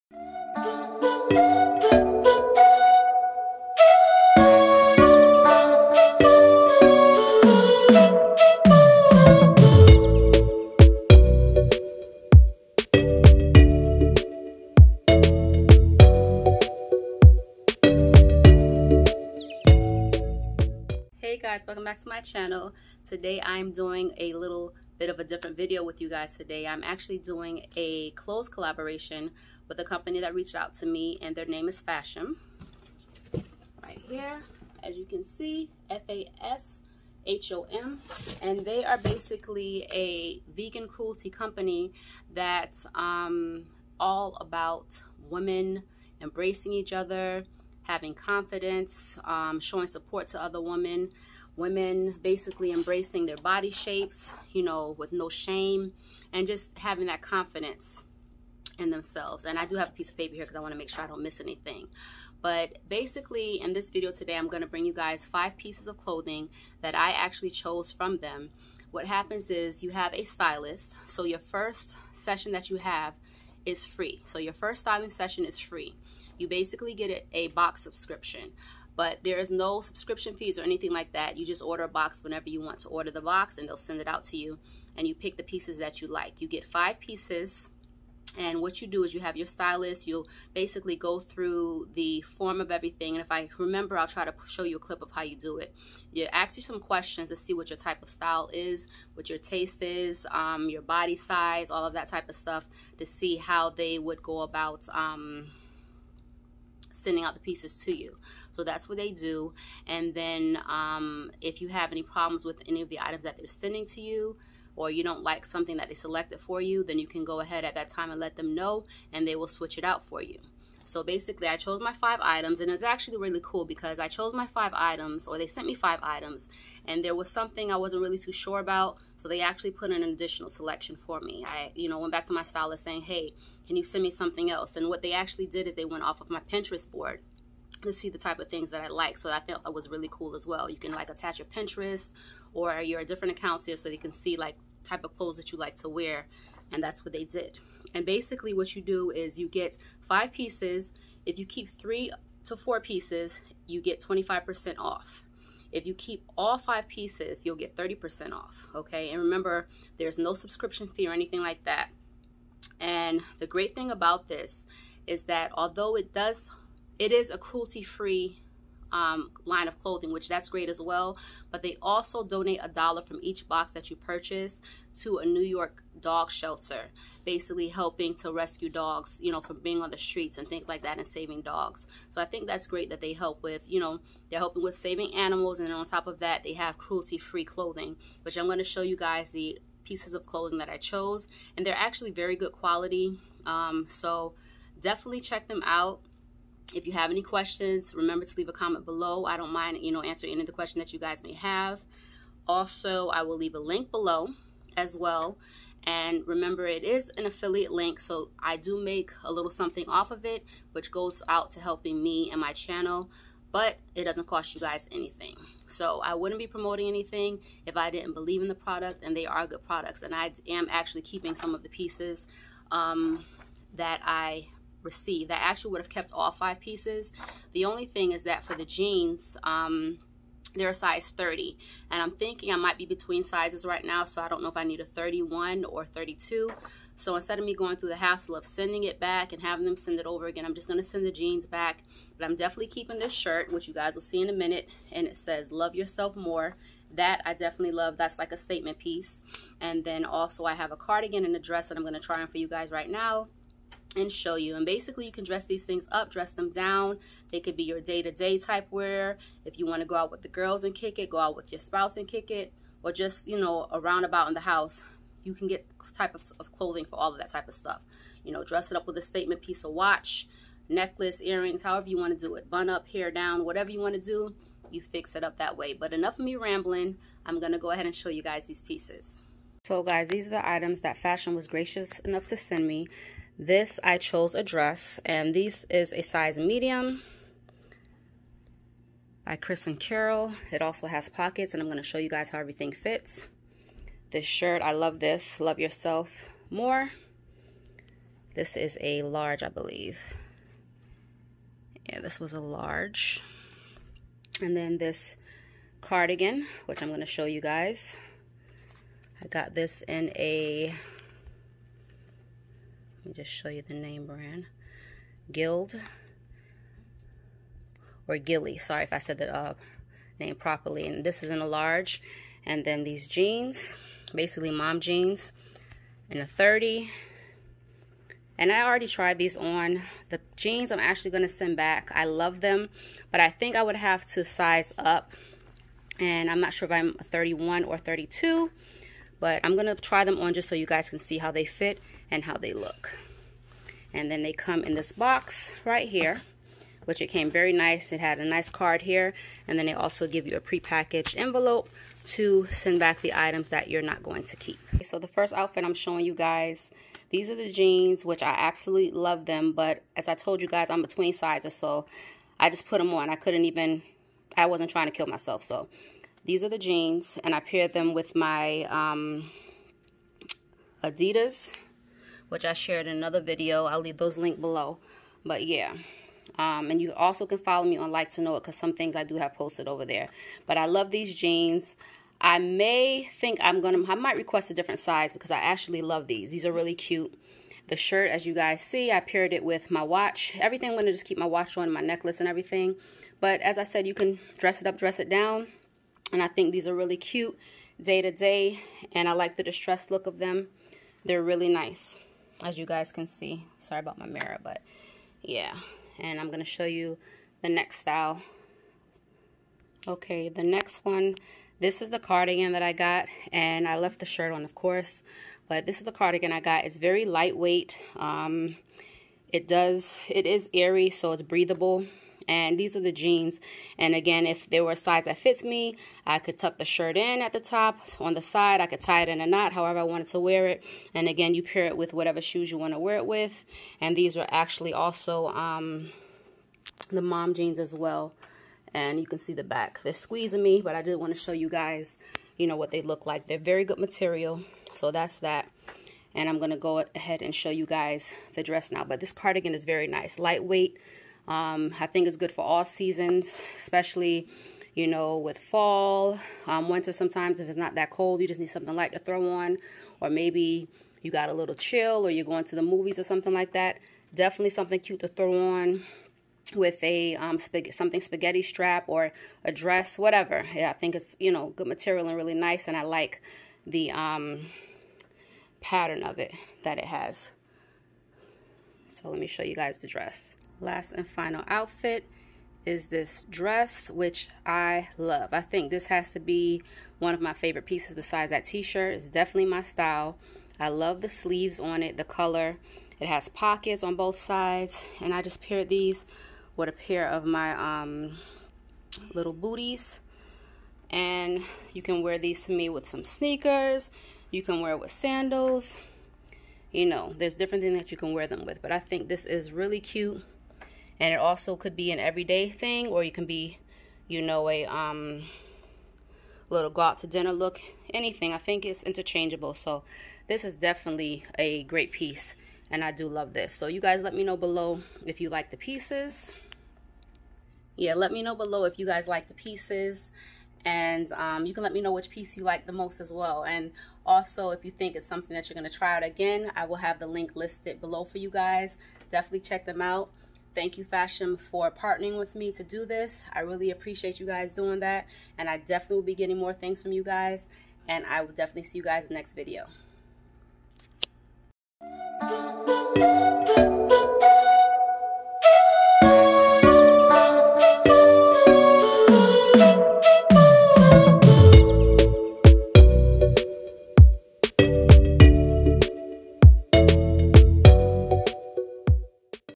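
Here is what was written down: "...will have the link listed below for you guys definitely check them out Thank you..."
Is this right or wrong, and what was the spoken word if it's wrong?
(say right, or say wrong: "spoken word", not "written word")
right.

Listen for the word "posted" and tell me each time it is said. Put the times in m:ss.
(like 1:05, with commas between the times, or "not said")
6:19.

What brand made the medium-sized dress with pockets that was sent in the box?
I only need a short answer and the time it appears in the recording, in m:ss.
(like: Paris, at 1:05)
Chris and Carol, at 4:49.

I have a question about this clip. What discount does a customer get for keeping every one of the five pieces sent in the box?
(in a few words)
30%.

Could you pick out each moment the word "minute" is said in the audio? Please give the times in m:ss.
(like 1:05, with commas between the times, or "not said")
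4:04.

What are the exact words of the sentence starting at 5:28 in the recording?
And I already tried these on.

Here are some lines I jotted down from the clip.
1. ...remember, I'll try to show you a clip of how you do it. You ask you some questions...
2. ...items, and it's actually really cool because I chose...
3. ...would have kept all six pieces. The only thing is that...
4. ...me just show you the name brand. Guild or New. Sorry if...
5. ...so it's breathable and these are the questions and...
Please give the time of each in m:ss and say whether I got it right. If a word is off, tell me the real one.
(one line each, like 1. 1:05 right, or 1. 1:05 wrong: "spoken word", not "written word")
1. 1:33 right
2. 2:02 right
3. 3:45 wrong: "five", not "six"
4. 5:13 wrong: "Gilly", not "New"
5. 7:00 wrong: "jeans", not "questions".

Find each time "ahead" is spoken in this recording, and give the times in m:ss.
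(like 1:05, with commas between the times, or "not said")
1:57, 4:37, 7:26.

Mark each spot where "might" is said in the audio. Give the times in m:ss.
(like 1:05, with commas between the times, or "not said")
3:52, 6:23.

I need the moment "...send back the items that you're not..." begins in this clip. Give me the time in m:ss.
5:52.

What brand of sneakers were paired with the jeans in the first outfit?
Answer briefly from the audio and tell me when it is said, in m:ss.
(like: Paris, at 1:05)
Adidas, at 6:10.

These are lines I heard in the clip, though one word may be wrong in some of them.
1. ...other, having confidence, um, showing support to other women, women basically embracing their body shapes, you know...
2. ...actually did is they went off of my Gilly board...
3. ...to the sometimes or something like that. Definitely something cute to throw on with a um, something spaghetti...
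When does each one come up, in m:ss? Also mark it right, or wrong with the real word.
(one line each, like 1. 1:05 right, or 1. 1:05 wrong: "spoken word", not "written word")
1. 0:46 right
2. 2:15 wrong: "Pinterest", not "Gilly"
3. 7:42 wrong: "movies", not "sometimes".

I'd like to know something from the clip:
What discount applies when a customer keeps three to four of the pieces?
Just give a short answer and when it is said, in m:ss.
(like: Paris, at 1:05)
25%, at 2:33.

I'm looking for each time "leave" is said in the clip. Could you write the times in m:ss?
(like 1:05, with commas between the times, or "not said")
3:18, 3:23, 6:13.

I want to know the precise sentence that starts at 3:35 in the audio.
So I wouldn't be promoting anything if I didn't believe in the product, and they are good products.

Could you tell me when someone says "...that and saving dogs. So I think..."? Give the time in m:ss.
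3:00.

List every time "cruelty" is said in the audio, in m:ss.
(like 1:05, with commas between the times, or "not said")
0:40, 2:47, 3:06.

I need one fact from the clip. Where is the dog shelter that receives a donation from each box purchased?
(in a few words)
New York.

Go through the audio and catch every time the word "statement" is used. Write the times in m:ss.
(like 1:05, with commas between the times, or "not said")
4:08, 4:29.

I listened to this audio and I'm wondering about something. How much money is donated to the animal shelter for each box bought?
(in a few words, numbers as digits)
a dollar.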